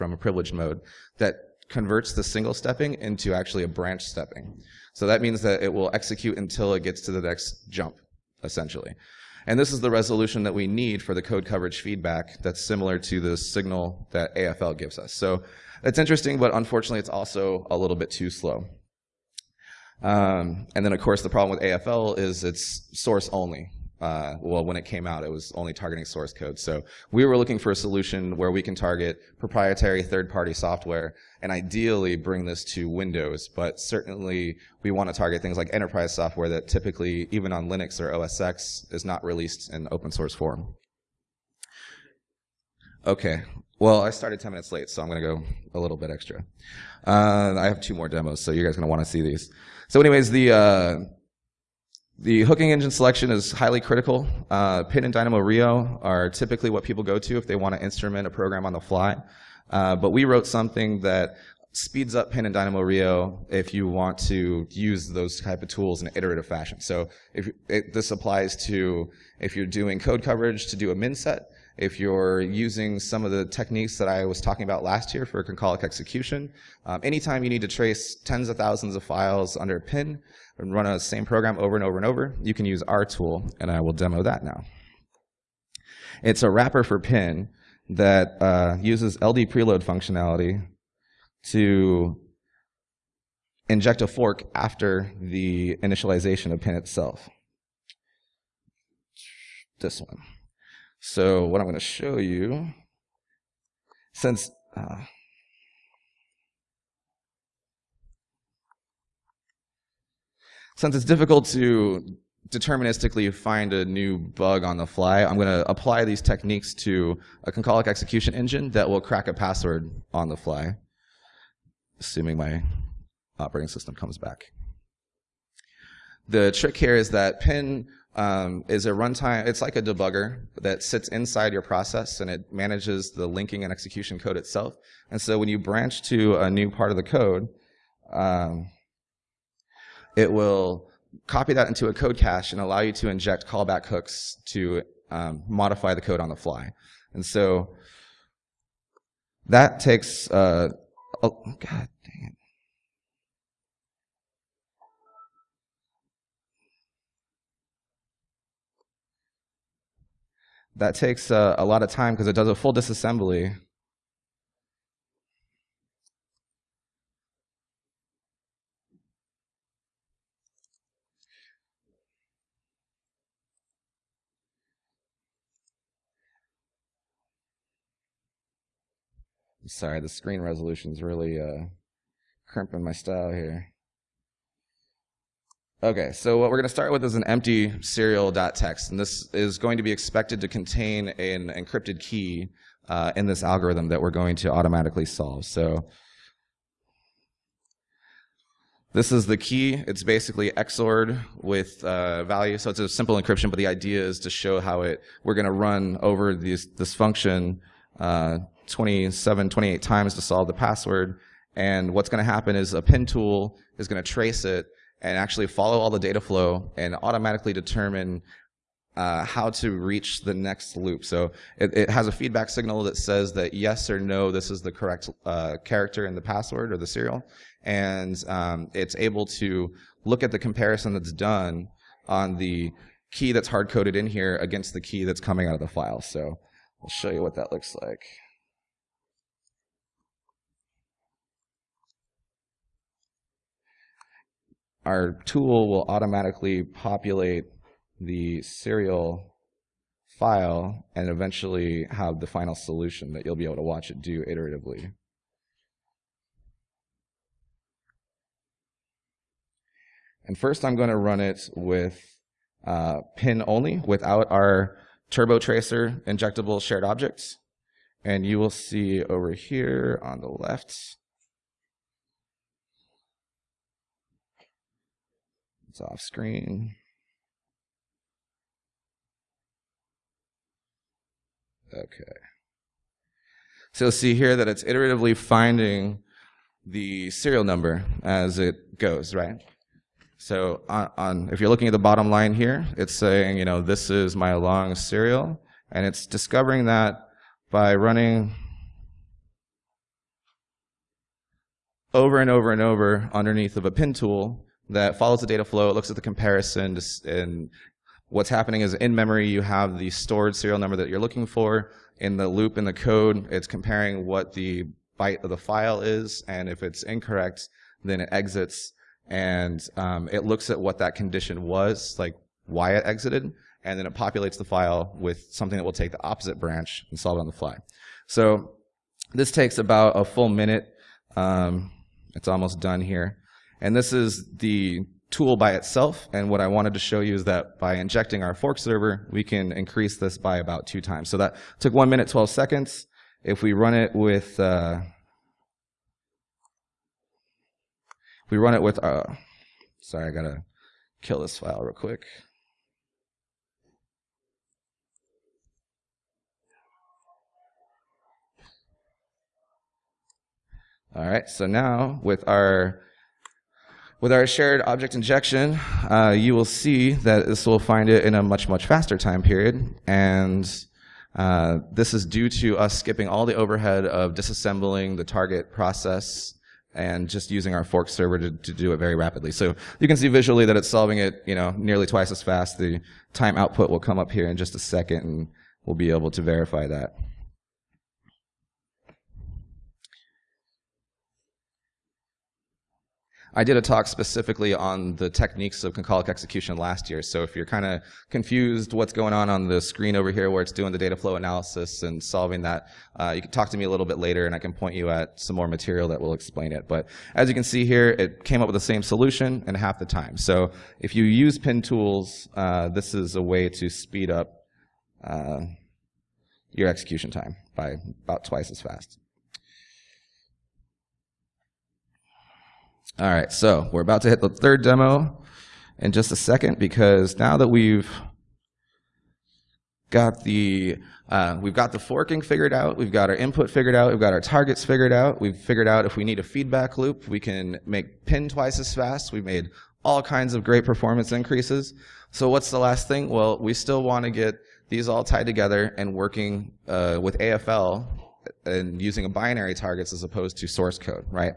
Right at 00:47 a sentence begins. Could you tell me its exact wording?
Uh, I have two more demos, so you guys are going to want to see these.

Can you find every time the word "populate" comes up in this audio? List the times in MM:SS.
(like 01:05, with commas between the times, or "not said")
04:06, 05:23.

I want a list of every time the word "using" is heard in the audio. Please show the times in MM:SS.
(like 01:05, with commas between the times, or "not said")
01:12, 06:17, 07:28.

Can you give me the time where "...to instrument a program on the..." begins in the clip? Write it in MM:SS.
00:57.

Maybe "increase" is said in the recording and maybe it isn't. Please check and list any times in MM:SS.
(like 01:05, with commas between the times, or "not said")
05:39, 07:21.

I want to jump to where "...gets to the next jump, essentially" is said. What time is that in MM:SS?
00:06.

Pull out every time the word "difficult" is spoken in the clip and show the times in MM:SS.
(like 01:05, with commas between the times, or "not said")
01:51.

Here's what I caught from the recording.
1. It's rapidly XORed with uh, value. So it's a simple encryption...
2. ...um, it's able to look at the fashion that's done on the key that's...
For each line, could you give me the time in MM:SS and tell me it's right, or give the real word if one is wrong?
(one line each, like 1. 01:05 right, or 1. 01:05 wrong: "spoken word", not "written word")
1. 03:19 wrong: "basically", not "rapidly"
2. 03:48 wrong: "comparison", not "fashion".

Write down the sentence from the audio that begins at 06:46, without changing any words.
But as you can see here, it came up with the same solution in half the time.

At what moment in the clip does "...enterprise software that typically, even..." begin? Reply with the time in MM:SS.
00:35.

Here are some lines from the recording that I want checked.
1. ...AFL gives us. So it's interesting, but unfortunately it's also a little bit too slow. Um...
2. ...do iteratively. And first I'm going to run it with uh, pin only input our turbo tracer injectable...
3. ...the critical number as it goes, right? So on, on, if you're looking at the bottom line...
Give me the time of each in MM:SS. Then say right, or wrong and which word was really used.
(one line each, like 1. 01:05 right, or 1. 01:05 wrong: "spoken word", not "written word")
1. 00:14 right
2. 04:14 wrong: "without", not "input"
3. 04:46 wrong: "serial", not "critical".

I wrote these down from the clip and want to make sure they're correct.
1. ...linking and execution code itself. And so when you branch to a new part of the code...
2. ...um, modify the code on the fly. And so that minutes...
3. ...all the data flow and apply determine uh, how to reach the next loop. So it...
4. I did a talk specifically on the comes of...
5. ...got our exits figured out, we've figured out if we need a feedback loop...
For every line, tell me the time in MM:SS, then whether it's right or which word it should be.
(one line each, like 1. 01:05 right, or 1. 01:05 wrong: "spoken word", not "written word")
1. 02:13 right
2. 02:25 wrong: "takes", not "minutes"
3. 03:35 wrong: "automatically", not "apply"
4. 06:33 wrong: "techniques", not "comes"
5. 07:13 wrong: "targets", not "exits".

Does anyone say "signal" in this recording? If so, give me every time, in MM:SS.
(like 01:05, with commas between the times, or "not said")
00:13, 03:42.